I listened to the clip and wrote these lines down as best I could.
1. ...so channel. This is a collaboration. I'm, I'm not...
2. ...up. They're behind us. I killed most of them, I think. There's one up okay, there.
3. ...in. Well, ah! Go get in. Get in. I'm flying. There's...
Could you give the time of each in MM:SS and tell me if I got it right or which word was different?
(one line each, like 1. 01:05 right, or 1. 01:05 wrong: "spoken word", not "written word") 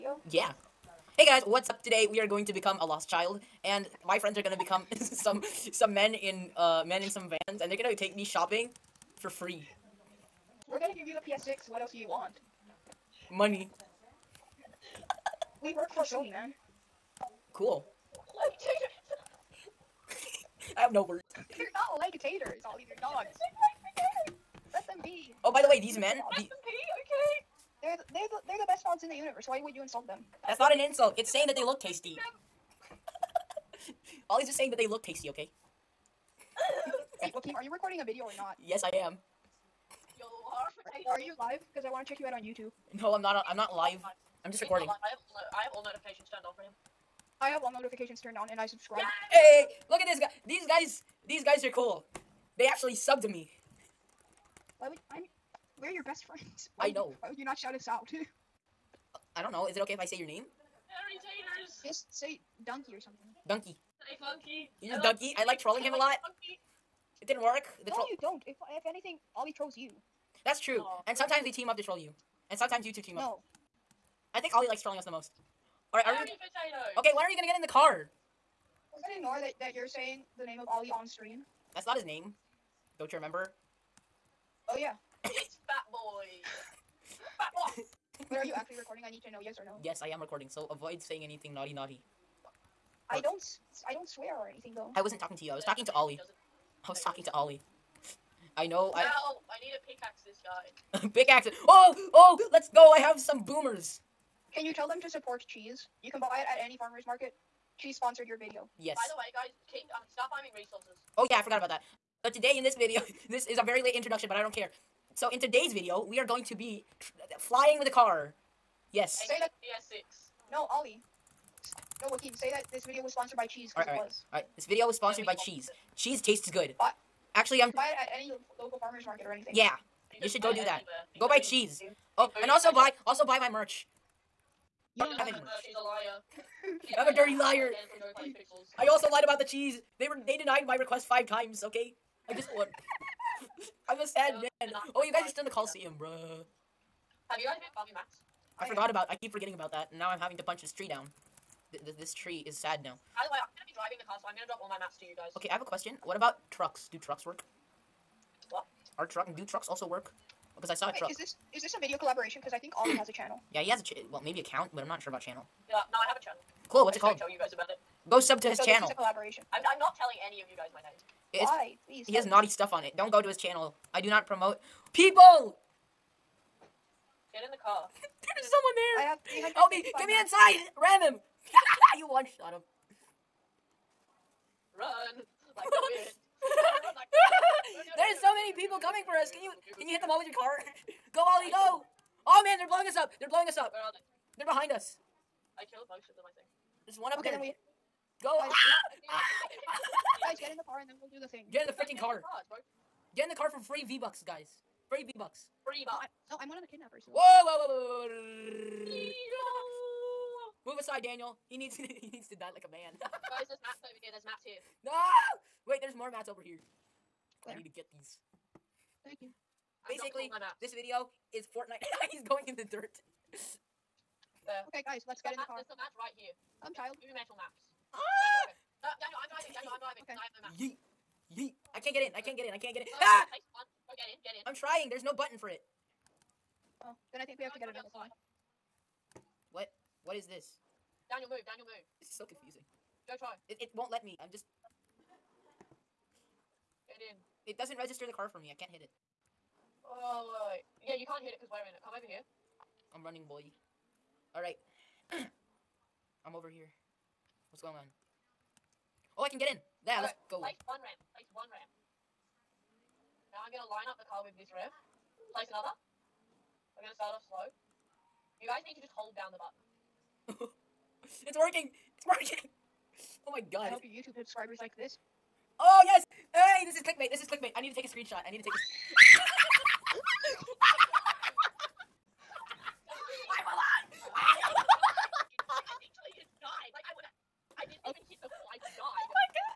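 1. 02:48 right
2. 03:13 right
3. 03:52 wrong: "trying", not "flying".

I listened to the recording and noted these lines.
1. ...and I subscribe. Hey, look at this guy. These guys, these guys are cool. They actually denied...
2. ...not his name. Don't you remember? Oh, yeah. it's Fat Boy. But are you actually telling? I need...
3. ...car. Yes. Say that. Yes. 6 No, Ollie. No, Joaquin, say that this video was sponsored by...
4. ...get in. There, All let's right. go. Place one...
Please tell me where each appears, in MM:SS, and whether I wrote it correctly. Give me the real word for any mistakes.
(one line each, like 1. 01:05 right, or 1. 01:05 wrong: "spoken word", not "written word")
1. 00:48 wrong: "subbed", not "denied"
2. 01:21 wrong: "recording", not "telling"
3. 01:57 right
4. 04:19 right.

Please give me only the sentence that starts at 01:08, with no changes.
If if anything, Ollie trolls you.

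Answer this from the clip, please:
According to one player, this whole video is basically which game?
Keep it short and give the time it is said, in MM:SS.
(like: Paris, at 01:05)
Fortnite, at 03:41.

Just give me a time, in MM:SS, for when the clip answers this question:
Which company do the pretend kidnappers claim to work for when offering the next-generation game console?
00:16.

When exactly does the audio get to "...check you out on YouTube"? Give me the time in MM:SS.
00:42.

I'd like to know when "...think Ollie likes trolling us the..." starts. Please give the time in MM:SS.
01:14.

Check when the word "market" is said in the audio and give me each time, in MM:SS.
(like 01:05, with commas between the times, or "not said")
01:47, 02:09.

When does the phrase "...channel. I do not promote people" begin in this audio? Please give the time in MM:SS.
02:53.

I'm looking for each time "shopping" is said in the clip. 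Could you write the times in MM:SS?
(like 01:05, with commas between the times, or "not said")
00:08.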